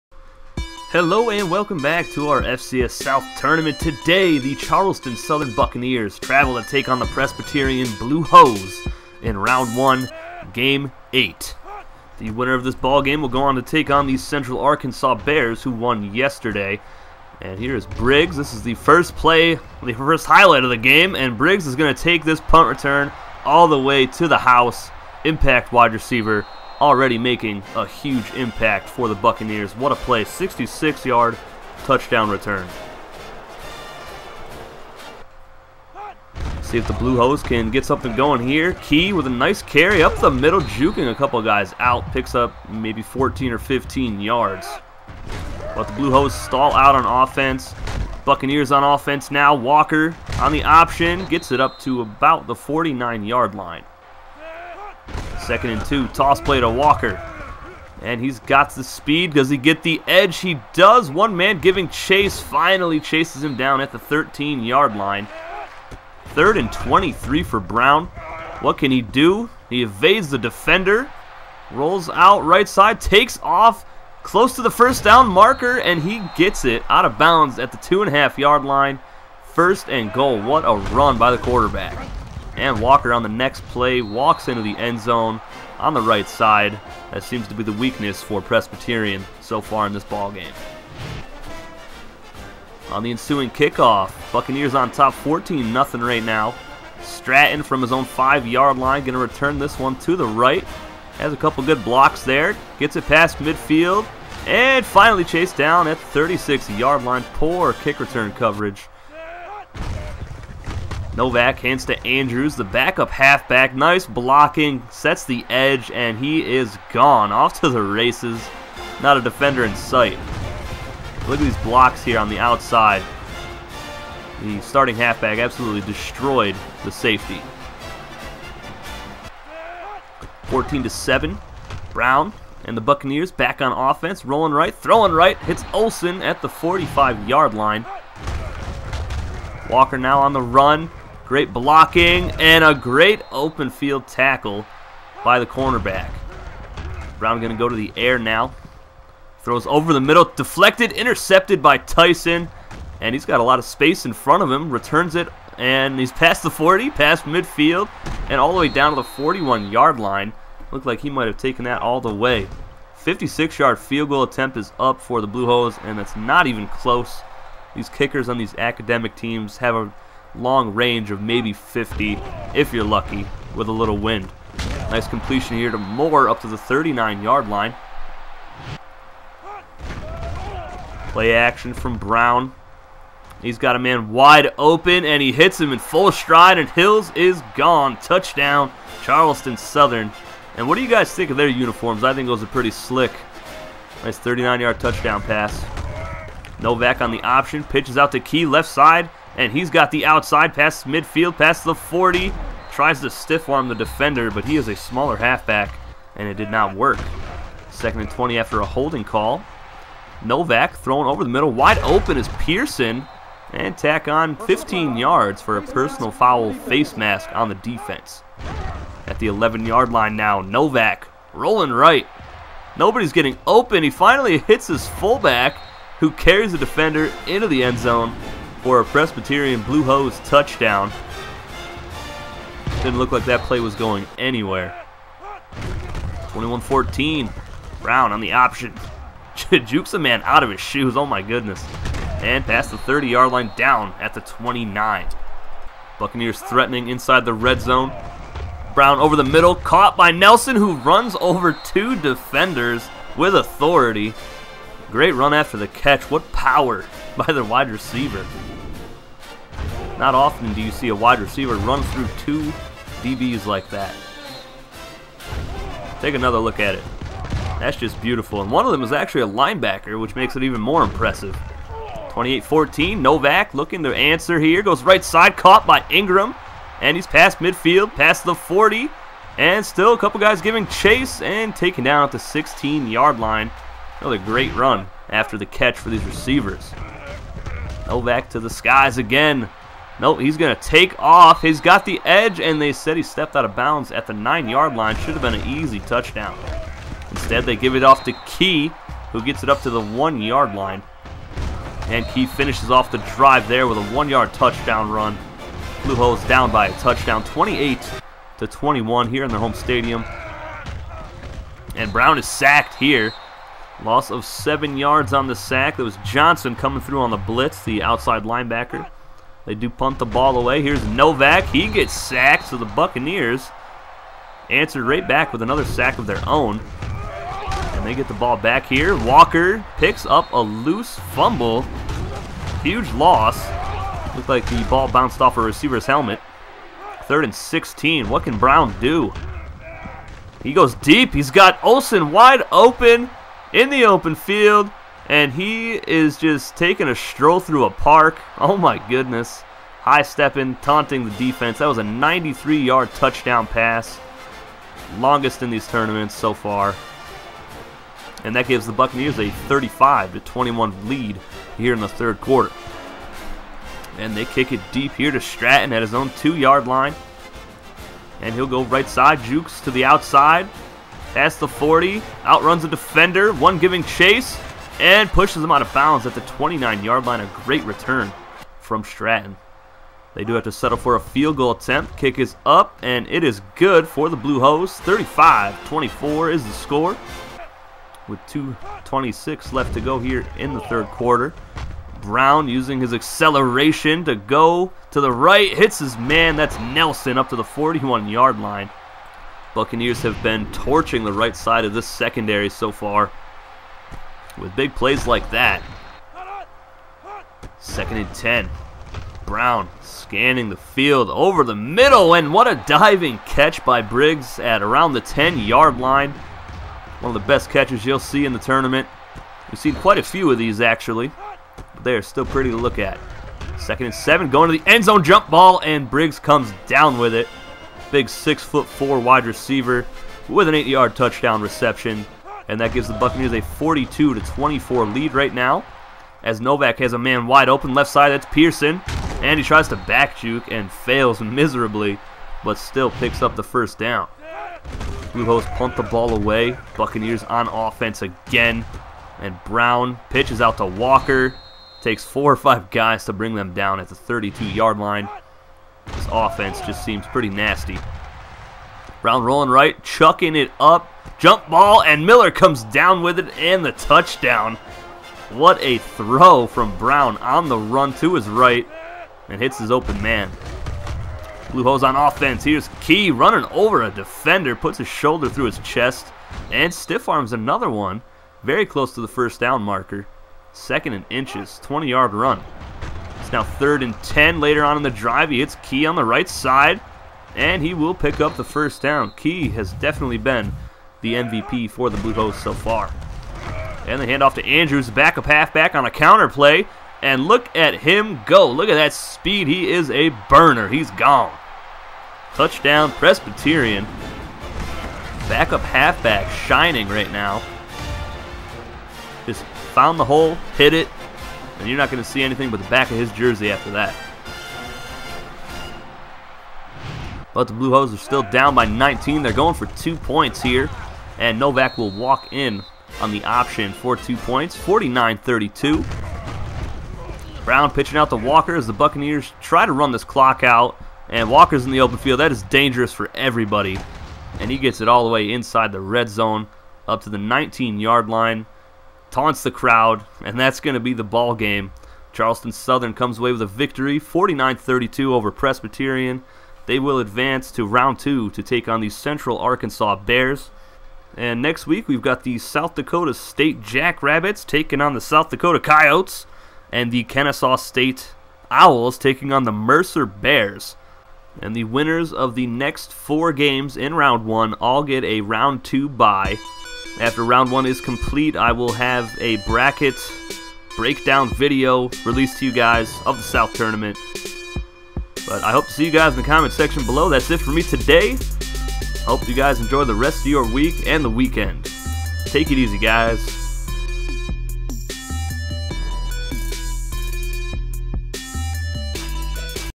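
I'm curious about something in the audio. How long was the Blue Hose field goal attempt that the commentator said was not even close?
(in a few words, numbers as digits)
56 yards.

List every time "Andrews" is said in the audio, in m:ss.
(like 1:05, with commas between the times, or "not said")
1:52, 8:14.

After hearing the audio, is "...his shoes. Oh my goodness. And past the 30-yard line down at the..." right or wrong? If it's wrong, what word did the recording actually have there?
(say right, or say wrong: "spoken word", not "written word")
right.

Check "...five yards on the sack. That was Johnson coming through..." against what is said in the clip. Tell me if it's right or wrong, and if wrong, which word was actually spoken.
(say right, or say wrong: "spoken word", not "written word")
wrong: "seven", not "five".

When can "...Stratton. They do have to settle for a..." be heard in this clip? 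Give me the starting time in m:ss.
6:18.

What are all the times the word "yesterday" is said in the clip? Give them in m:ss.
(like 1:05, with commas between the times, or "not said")
0:16.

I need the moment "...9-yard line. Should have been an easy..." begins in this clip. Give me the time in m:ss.
4:54.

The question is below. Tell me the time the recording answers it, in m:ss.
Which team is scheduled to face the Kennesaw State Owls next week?
9:19.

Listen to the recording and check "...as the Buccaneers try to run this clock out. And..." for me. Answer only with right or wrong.
right.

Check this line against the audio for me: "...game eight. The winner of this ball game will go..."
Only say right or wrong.
right.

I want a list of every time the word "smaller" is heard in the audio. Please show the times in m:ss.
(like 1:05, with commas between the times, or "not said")
3:24.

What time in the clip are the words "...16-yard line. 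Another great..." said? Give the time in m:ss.
4:42.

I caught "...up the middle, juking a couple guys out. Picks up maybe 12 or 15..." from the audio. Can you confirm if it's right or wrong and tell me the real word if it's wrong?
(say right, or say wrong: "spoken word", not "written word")
wrong: "14", not "12".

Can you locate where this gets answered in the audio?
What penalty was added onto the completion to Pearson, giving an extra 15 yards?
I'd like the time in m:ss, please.
3:36.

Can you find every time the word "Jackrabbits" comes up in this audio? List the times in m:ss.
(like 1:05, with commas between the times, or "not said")
9:13.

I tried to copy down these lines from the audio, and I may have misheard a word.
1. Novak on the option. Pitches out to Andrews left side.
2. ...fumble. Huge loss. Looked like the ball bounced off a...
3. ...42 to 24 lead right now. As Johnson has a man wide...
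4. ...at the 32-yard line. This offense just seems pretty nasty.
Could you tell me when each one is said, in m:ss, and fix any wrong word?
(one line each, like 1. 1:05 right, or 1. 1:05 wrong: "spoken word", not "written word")
1. 3:16 wrong: "Key", not "Andrews"
2. 5:31 right
3. 7:13 wrong: "Novak", not "Johnson"
4. 7:33 right.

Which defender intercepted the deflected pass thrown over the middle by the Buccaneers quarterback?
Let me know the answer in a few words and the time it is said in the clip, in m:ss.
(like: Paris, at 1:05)
Tyson, at 2:31.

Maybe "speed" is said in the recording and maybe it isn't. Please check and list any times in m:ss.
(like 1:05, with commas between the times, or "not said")
0:58, 8:18.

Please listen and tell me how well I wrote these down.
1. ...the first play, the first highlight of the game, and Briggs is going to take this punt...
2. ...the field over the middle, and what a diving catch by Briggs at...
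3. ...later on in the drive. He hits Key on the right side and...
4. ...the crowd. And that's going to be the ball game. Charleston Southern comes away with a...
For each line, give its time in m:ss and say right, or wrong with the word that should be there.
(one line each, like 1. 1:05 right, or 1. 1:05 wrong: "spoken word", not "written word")
1. 0:18 right
2. 6:50 right
3. 8:04 right
4. 8:59 right.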